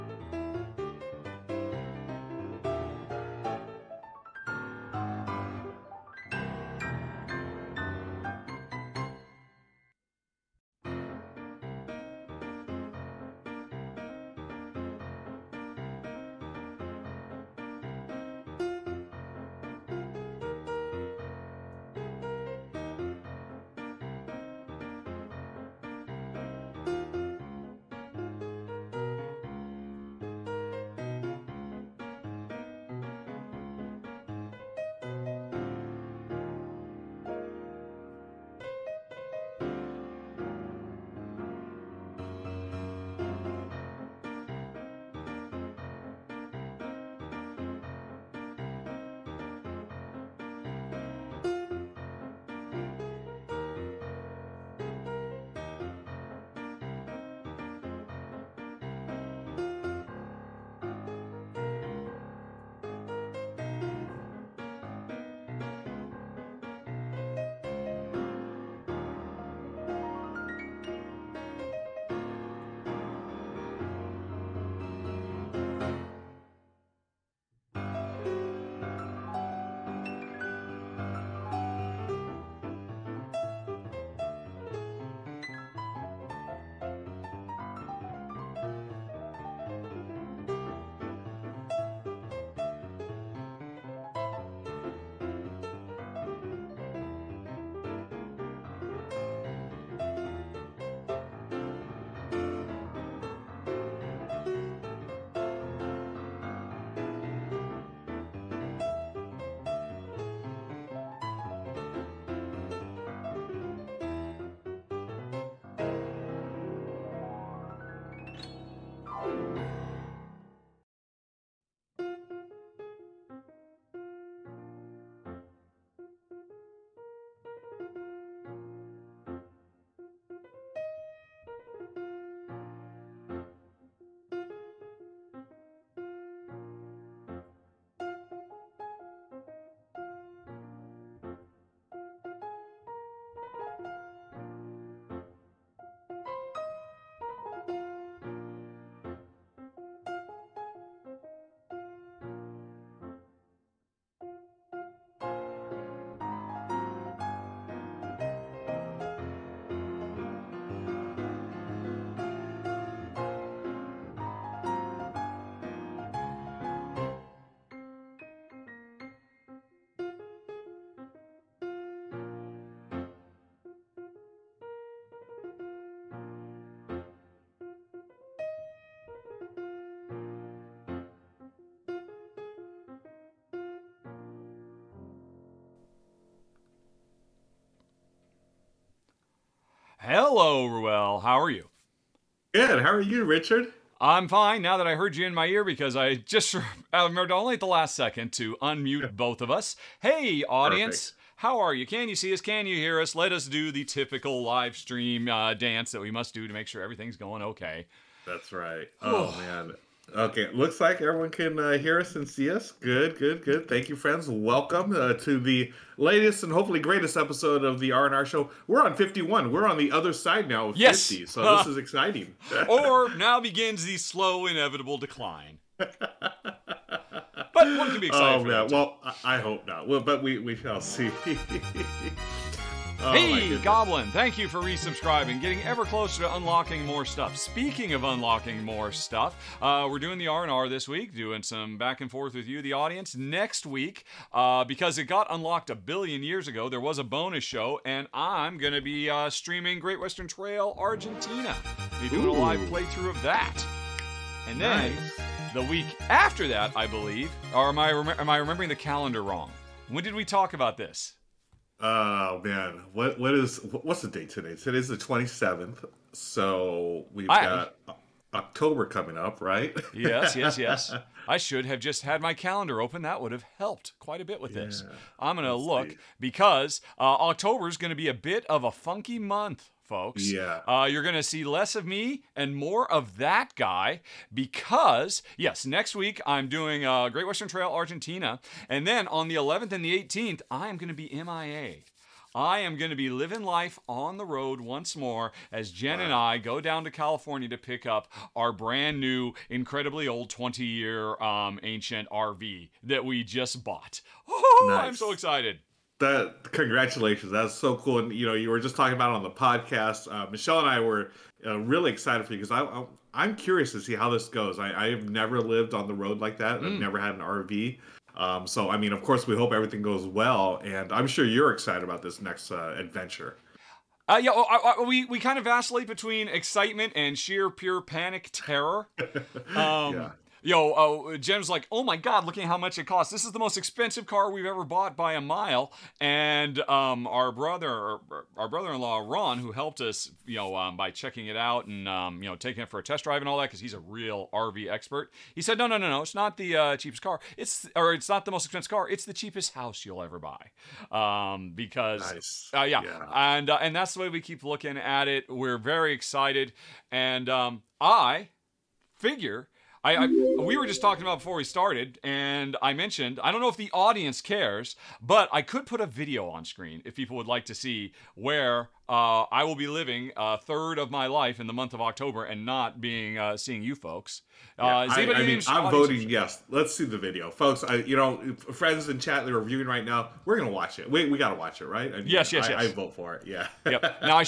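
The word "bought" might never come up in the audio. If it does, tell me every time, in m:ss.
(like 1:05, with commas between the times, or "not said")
5:03, 5:34.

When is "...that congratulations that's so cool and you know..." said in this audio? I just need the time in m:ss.
5:05.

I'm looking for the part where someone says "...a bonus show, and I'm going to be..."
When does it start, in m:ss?
4:06.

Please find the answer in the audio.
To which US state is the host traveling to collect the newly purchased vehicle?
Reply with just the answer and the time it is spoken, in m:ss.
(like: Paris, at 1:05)
California, at 4:56.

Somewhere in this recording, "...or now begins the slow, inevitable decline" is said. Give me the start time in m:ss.
3:42.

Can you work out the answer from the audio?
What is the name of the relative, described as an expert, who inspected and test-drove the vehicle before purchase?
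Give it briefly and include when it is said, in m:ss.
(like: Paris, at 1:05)
Ron, at 5:39.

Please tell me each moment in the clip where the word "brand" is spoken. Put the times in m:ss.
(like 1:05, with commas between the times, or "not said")
4:58.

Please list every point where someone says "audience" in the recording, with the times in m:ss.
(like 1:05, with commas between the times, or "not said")
3:20, 4:02, 6:03.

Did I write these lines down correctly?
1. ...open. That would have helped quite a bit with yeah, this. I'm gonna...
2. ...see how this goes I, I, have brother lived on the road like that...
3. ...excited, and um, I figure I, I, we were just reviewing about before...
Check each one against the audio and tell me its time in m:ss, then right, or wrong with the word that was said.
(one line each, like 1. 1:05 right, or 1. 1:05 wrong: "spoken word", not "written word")
1. 4:32 right
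2. 5:13 wrong: "never", not "brother"
3. 5:55 wrong: "talking", not "reviewing".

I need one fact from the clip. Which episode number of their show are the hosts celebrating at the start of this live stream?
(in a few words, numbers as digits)
51.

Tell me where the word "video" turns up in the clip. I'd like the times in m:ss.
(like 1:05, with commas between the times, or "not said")
6:05, 6:16.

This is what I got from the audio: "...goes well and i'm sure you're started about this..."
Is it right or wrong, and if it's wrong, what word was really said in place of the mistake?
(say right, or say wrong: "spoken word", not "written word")
wrong: "excited", not "started".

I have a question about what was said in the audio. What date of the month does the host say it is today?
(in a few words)
27th.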